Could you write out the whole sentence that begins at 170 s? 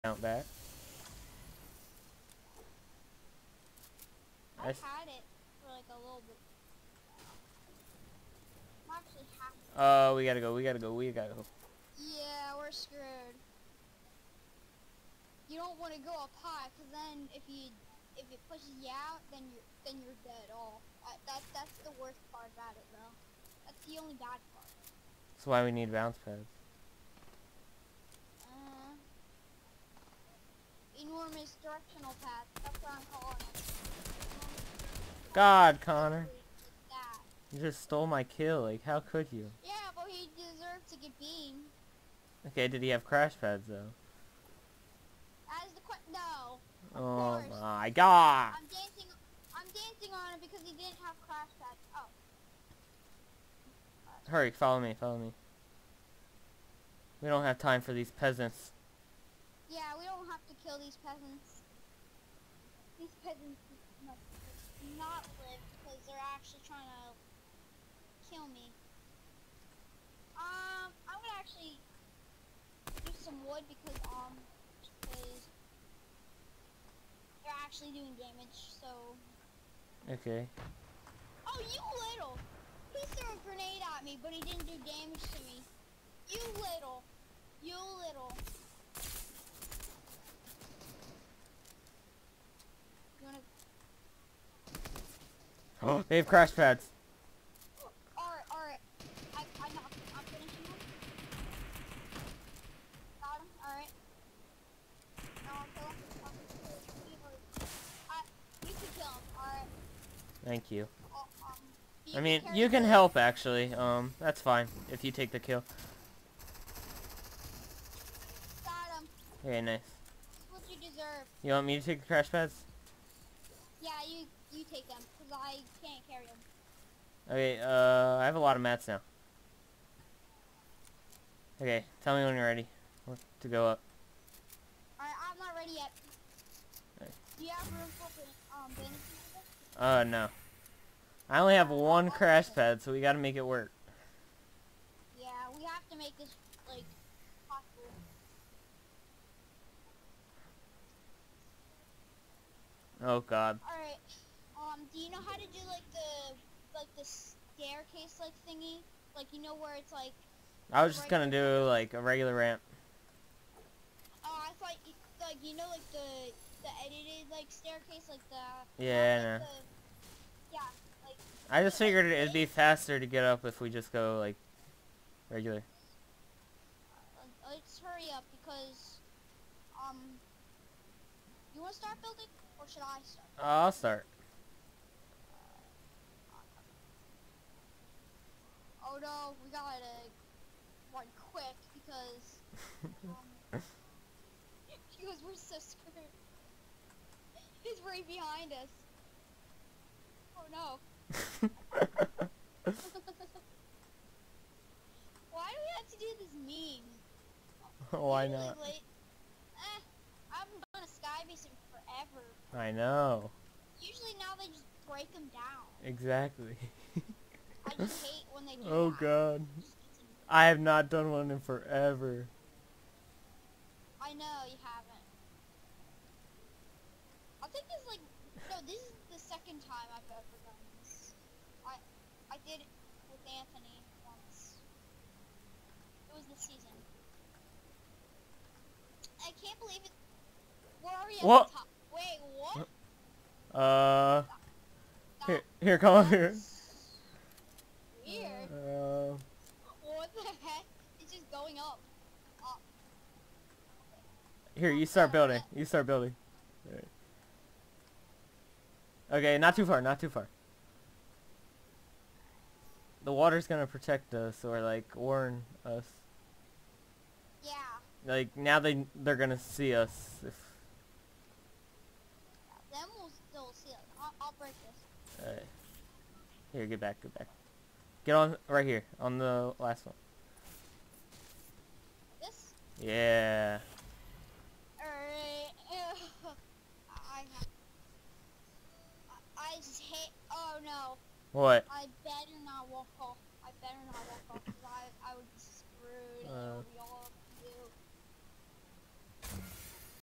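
yeah I just figured it'd be faster to get up if we just go like regular.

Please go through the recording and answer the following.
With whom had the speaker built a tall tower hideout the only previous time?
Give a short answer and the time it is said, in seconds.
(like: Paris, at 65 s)
Anthony, at 233 s.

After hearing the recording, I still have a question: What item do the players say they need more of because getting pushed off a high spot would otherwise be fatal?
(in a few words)
bounce pads.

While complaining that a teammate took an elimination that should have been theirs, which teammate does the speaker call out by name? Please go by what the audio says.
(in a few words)
Connor.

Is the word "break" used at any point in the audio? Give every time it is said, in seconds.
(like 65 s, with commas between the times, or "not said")
214 s, 274 s.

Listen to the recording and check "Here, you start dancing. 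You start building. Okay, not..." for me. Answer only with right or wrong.
wrong.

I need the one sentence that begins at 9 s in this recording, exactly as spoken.
Oh, we gotta go, we gotta go, we gotta go.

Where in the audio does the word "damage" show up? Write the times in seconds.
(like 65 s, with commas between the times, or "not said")
78 s, 84 s.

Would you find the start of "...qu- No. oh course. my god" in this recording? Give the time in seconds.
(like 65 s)
45 s.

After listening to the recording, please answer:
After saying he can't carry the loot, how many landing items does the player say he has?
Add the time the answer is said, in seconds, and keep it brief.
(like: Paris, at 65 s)
1, at 141 s.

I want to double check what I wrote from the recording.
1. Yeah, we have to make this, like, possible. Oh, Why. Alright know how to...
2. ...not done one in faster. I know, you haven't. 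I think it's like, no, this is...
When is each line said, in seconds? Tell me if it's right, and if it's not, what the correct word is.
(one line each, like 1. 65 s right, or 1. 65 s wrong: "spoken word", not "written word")
1. 145 s wrong: "God", not "Why"
2. 220 s wrong: "forever", not "faster".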